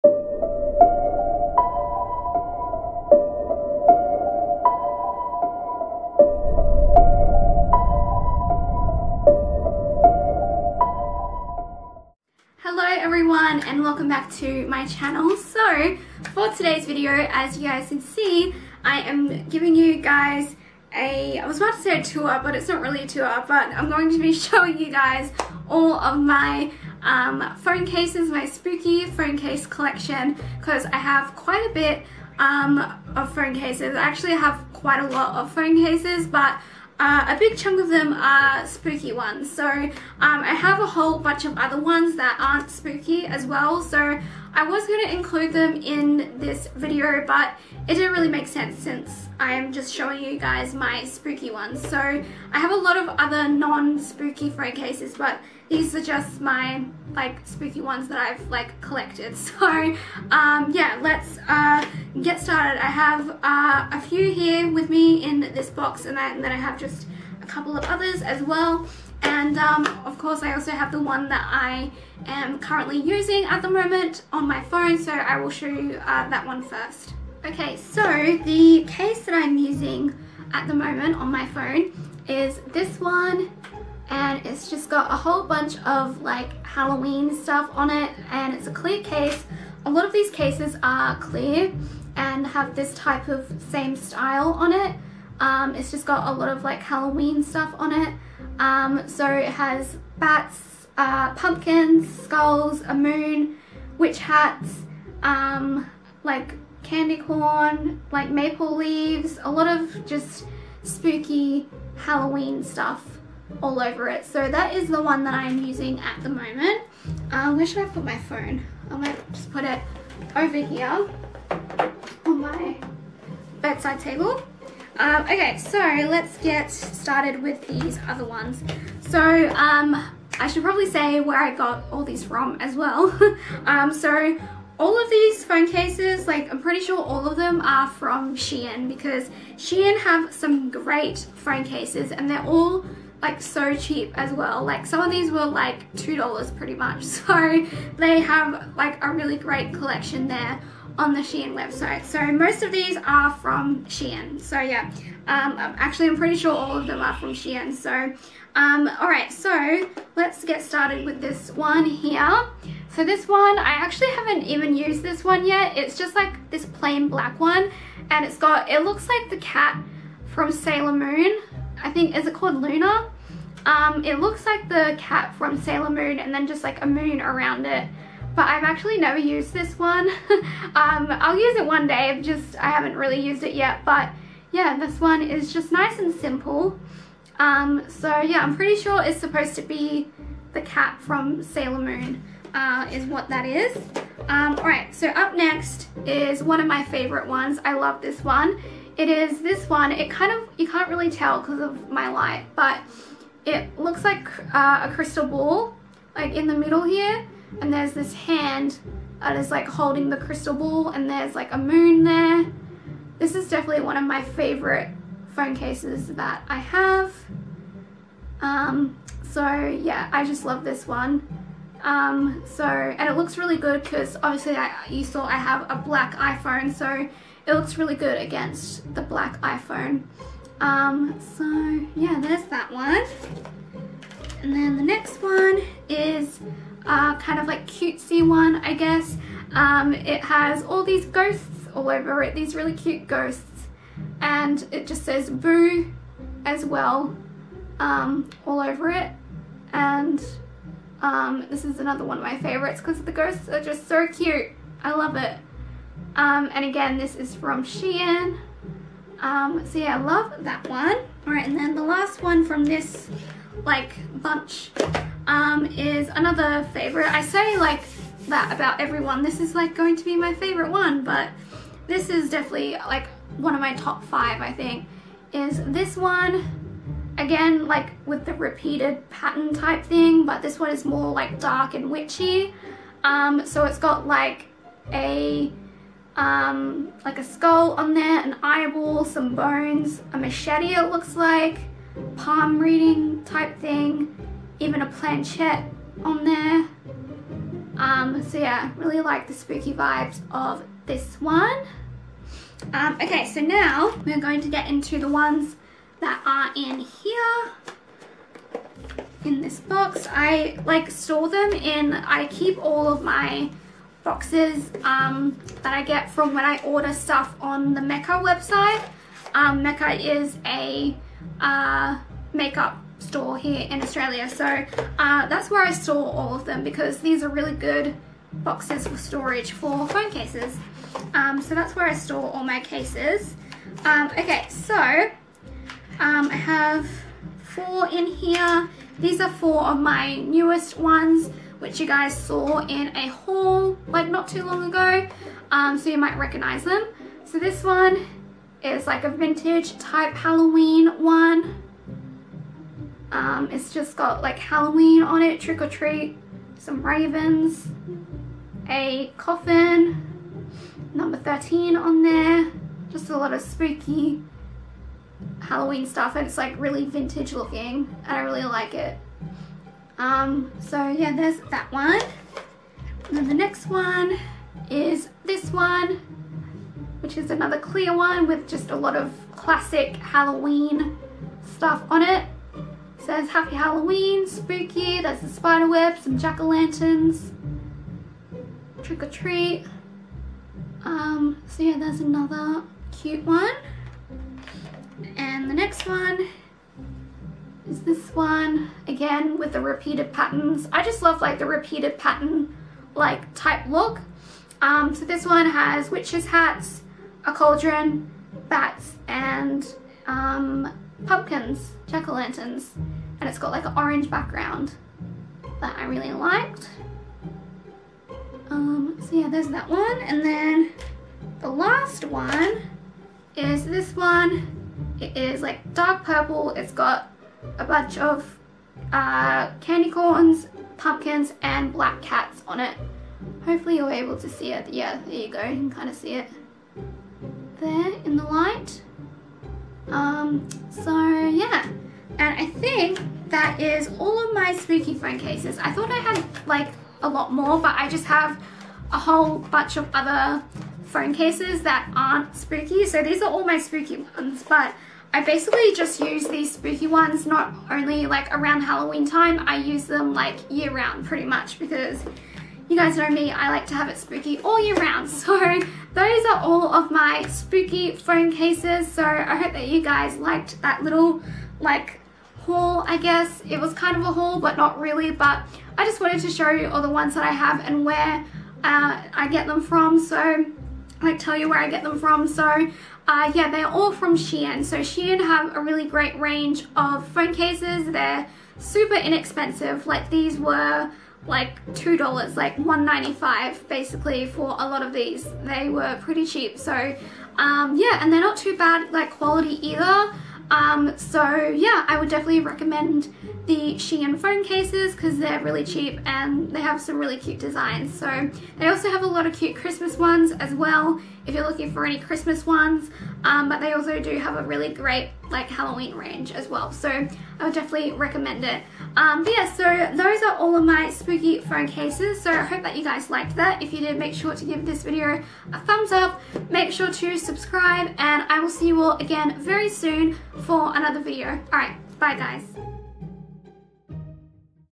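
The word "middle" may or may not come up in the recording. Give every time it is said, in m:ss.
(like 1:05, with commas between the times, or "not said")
3:26.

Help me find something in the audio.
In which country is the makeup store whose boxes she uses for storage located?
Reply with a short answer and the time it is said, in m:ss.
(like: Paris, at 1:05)
Australia, at 5:23.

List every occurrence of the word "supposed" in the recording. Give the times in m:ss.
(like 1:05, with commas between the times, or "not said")
3:09.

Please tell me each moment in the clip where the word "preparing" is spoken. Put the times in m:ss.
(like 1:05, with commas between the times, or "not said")
not said.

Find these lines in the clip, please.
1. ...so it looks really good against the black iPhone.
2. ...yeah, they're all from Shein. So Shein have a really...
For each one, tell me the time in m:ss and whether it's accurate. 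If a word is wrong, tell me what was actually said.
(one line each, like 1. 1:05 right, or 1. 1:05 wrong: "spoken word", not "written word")
1. 3:46 right
2. 8:03 right.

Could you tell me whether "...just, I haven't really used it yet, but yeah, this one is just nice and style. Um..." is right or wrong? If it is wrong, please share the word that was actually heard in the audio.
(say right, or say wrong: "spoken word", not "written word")
wrong: "simple", not "style".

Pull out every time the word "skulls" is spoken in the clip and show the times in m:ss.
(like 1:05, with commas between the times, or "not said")
1:42, 4:47.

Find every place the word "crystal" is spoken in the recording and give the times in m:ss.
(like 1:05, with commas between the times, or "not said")
3:24, 3:30.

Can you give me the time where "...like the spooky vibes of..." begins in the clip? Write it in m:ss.
4:59.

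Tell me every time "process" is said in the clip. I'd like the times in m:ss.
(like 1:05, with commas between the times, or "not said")
not said.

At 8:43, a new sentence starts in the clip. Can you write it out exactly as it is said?
If you did, make sure to give this video a thumbs up.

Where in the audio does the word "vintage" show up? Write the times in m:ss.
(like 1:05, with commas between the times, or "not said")
5:49, 6:06.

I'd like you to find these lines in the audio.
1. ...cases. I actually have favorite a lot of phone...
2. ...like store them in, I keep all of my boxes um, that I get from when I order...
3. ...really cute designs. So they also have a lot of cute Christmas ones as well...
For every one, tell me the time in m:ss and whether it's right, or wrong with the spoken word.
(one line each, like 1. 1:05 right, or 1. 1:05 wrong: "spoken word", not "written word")
1. 0:33 wrong: "quite", not "favorite"
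2. 5:10 right
3. 8:26 right.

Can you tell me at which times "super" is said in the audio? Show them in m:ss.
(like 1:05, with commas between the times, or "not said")
8:08.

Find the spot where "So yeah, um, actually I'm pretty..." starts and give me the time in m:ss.
2:34.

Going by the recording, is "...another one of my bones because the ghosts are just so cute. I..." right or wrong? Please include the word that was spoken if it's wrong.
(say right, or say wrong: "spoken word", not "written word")
wrong: "favorites", not "bones".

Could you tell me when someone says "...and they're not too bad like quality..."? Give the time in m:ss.
8:18.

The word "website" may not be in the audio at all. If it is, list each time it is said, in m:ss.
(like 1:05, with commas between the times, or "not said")
2:31, 5:18.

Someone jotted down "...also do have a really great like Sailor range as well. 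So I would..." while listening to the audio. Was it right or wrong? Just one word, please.
wrong.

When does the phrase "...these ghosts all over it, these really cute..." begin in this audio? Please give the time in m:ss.
4:00.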